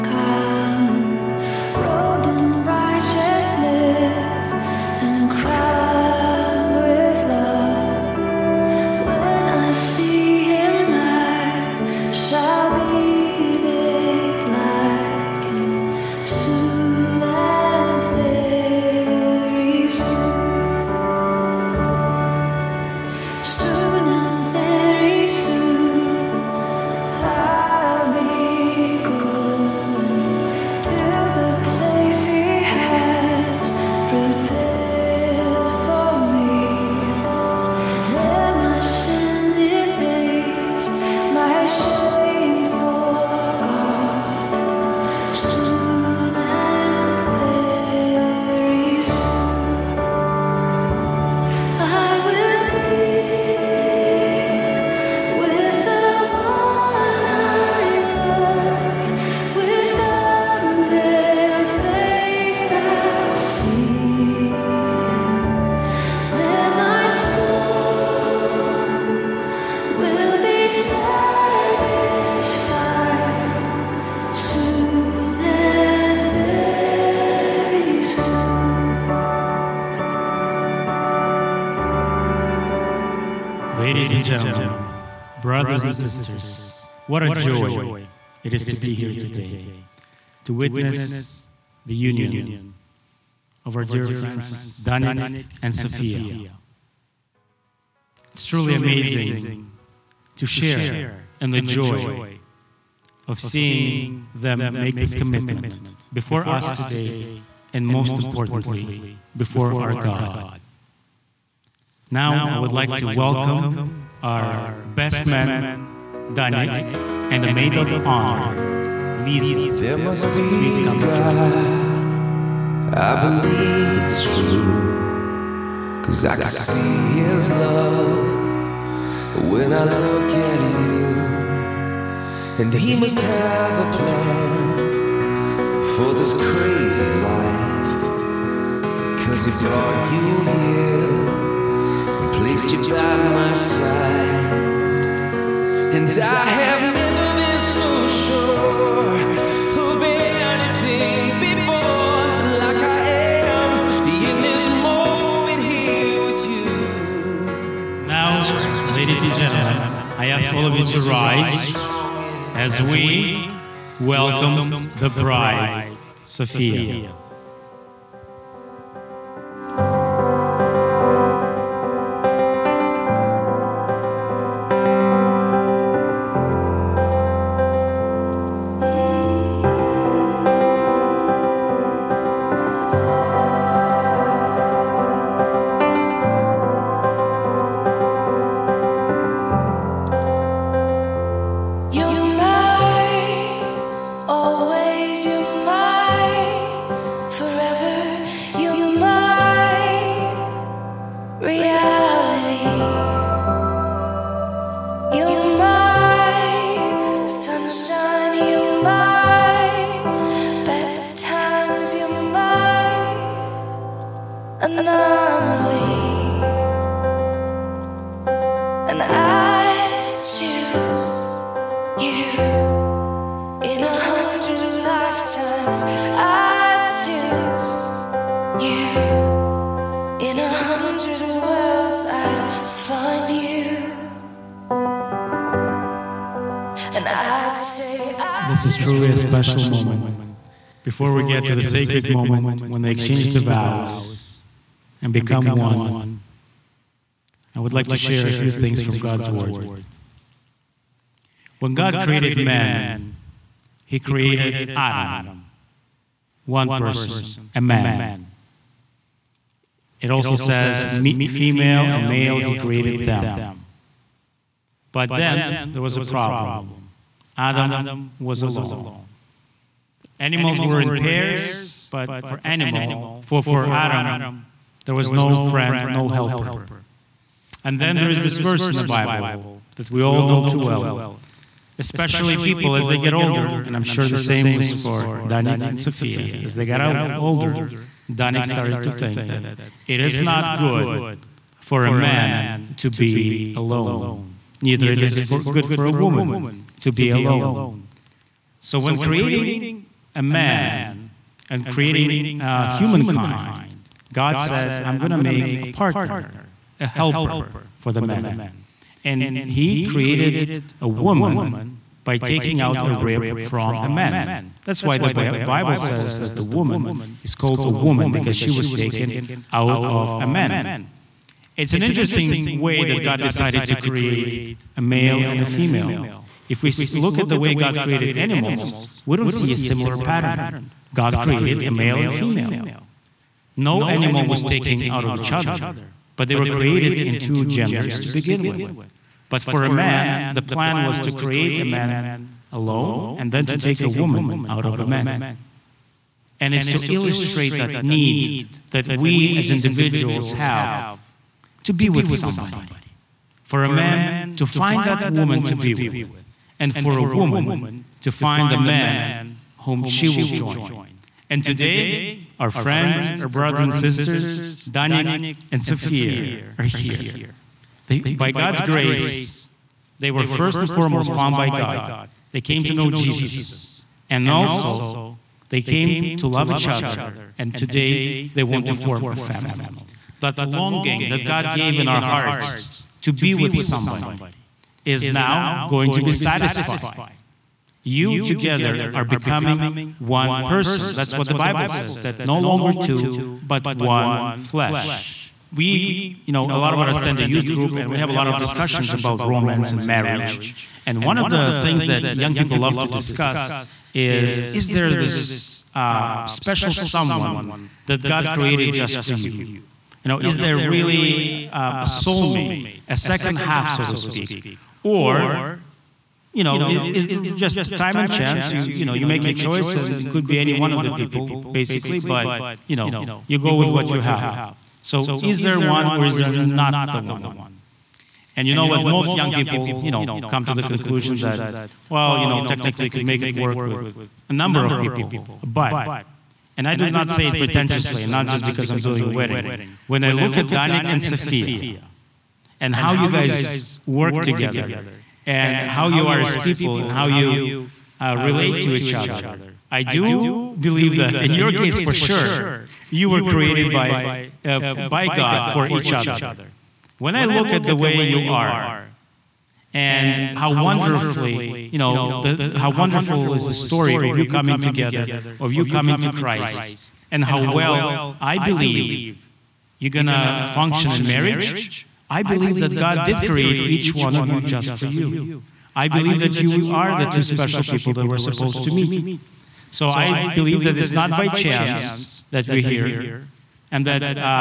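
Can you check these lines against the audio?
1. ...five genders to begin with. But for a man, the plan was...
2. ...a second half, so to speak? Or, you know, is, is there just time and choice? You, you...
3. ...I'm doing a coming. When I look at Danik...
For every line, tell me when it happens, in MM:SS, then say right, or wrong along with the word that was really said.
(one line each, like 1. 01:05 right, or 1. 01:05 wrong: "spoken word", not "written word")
1. 05:37 wrong: "two", not "five"
2. 06:52 wrong: "chance", not "choice"
3. 07:18 wrong: "wedding", not "coming".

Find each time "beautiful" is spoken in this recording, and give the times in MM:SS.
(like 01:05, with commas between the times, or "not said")
not said.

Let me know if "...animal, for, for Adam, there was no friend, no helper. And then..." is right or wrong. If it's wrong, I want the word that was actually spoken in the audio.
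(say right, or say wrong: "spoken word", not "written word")
right.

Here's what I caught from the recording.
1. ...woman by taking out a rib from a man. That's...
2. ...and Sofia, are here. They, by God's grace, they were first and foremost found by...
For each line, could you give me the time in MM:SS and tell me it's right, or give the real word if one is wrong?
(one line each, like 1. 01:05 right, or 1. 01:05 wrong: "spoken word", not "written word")
1. 05:10 right
2. 06:05 right.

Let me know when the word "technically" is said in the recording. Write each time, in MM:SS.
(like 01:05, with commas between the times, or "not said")
07:12.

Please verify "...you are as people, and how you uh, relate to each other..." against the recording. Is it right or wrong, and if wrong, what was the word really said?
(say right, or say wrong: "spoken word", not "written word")
right.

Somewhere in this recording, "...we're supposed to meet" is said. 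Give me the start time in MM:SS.
07:58.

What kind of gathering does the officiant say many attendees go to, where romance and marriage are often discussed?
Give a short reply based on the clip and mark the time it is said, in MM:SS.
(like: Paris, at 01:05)
Youth group, at 06:37.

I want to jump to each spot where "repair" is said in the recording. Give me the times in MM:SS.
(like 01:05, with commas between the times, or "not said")
not said.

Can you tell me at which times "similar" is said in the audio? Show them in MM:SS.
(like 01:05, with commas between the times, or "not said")
05:29.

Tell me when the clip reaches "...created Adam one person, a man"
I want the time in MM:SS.
04:13.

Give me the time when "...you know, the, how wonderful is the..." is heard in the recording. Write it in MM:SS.
07:41.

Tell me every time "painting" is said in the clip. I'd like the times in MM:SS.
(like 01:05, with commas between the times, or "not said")
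not said.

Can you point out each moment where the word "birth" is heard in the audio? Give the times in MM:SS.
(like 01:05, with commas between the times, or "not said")
not said.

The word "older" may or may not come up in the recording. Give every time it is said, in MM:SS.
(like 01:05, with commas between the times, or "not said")
04:43, 04:47.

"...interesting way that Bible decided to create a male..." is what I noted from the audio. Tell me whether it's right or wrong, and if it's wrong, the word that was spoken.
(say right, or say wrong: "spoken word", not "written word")
wrong: "God", not "Bible".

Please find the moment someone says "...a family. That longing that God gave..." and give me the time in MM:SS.
06:19.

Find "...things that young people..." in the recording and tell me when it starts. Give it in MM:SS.
06:41.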